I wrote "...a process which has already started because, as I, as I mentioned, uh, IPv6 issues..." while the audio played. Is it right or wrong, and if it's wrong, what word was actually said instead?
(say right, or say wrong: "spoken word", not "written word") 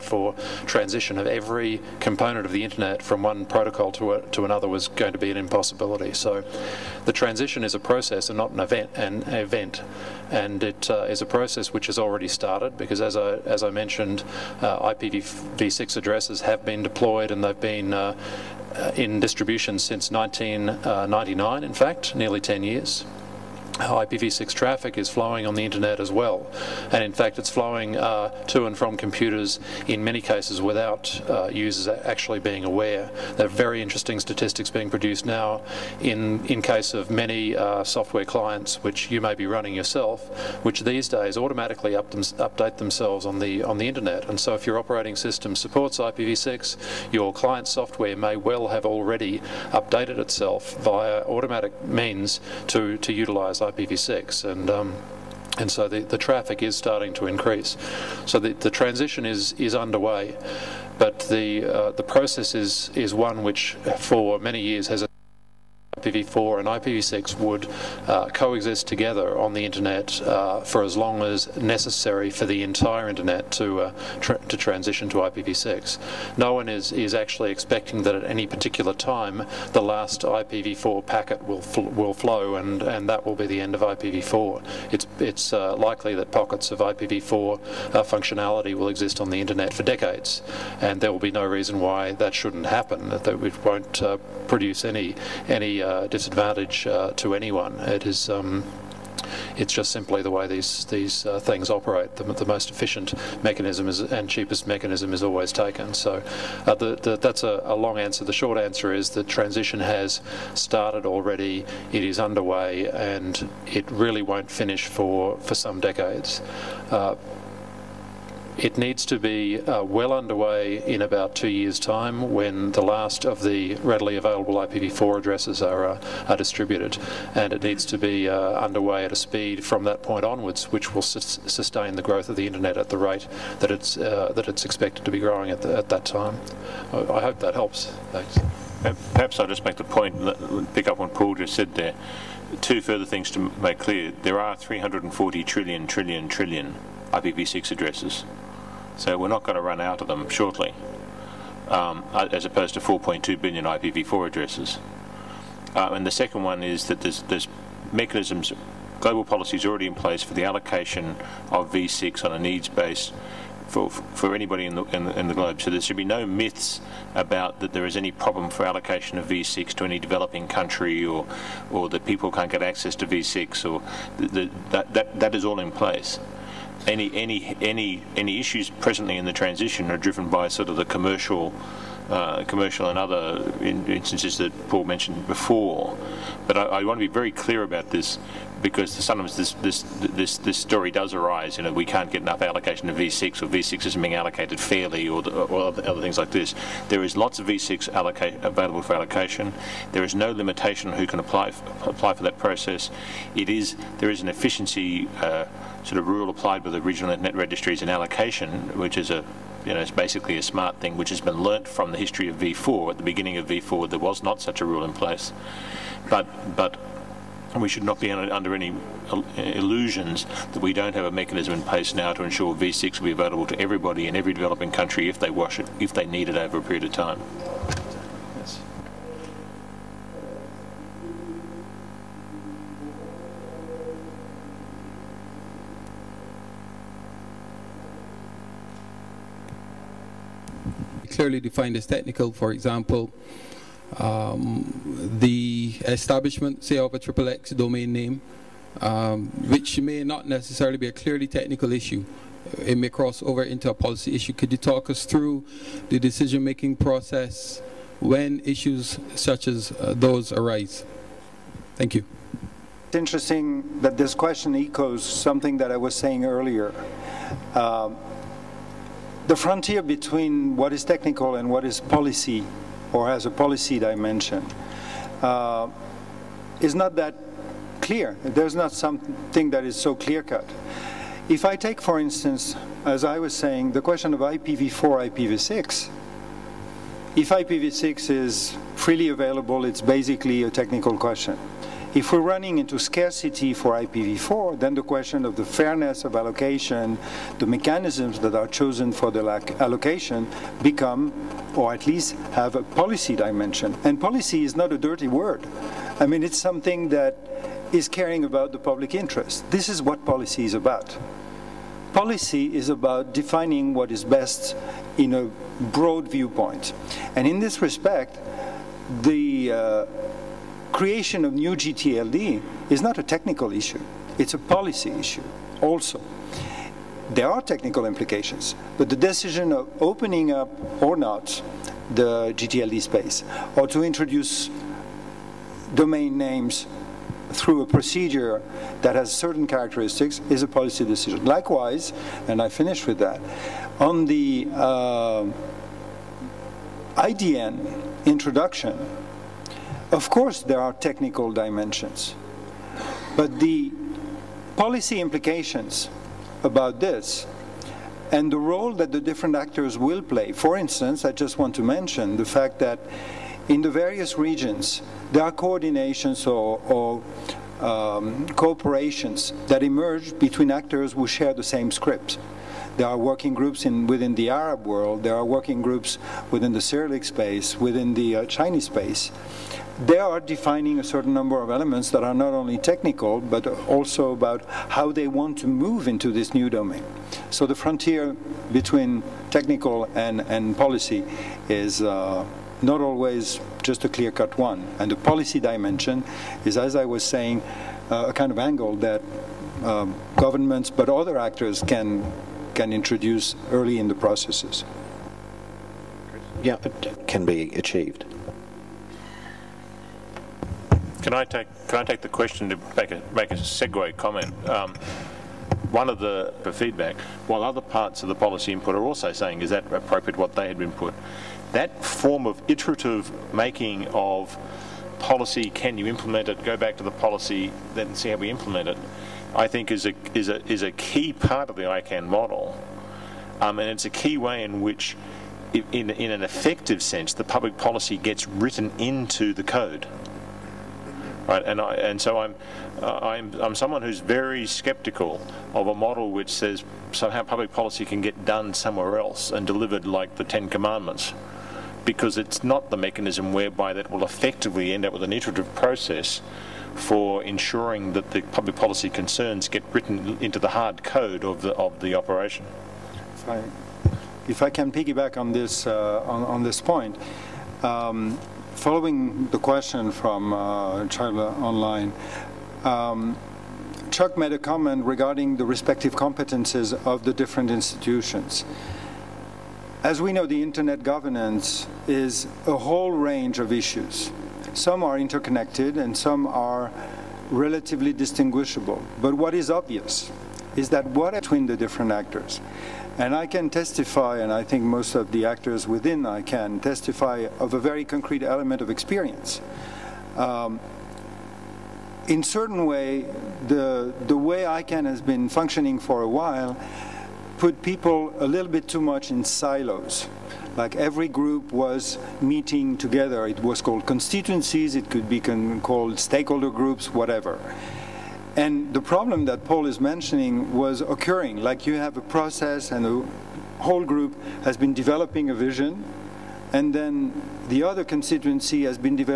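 wrong: "addresses", not "issues".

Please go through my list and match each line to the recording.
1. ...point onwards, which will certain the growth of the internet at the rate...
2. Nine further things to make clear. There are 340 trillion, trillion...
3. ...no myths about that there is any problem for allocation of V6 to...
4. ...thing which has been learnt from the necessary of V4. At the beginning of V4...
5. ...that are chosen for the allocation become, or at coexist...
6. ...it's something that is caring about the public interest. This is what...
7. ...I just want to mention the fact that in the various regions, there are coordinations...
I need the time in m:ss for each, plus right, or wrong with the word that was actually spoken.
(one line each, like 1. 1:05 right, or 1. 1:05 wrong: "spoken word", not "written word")
1. 2:10 wrong: "sustain", not "certain"
2. 2:22 wrong: "Two", not "Nine"
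3. 2:46 right
4. 3:30 wrong: "history", not "necessary"
5. 4:58 wrong: "least", not "coexist"
6. 5:06 right
7. 6:01 right.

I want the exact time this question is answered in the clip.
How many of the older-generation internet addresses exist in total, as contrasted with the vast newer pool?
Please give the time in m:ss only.
2:32.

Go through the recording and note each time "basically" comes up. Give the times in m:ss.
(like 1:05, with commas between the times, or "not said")
3:29, 4:49.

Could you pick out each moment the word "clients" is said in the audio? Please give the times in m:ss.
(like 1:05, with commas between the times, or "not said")
0:38, 0:47.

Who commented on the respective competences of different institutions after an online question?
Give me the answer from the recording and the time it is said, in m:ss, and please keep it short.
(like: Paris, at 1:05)
Chuck, at 7:53.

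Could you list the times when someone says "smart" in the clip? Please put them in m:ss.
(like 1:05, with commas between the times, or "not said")
3:30.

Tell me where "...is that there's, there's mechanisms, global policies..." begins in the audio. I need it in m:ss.
2:36.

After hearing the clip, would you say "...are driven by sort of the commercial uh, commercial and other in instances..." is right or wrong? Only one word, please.
right.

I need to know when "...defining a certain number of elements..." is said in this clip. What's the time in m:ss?
6:20.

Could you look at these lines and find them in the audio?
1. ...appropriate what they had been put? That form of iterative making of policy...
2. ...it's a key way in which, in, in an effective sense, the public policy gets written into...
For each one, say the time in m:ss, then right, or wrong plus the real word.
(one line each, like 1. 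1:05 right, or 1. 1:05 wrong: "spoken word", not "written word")
1. 6:59 right
2. 7:13 right.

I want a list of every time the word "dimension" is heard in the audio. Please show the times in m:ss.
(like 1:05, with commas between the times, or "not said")
4:33, 5:03, 5:51, 6:35.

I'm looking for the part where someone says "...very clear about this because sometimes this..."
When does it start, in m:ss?
3:07.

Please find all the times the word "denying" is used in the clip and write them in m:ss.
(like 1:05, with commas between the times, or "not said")
not said.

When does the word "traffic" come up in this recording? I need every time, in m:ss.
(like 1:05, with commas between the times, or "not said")
0:24, 0:56.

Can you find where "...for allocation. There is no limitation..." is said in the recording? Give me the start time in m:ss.
3:18.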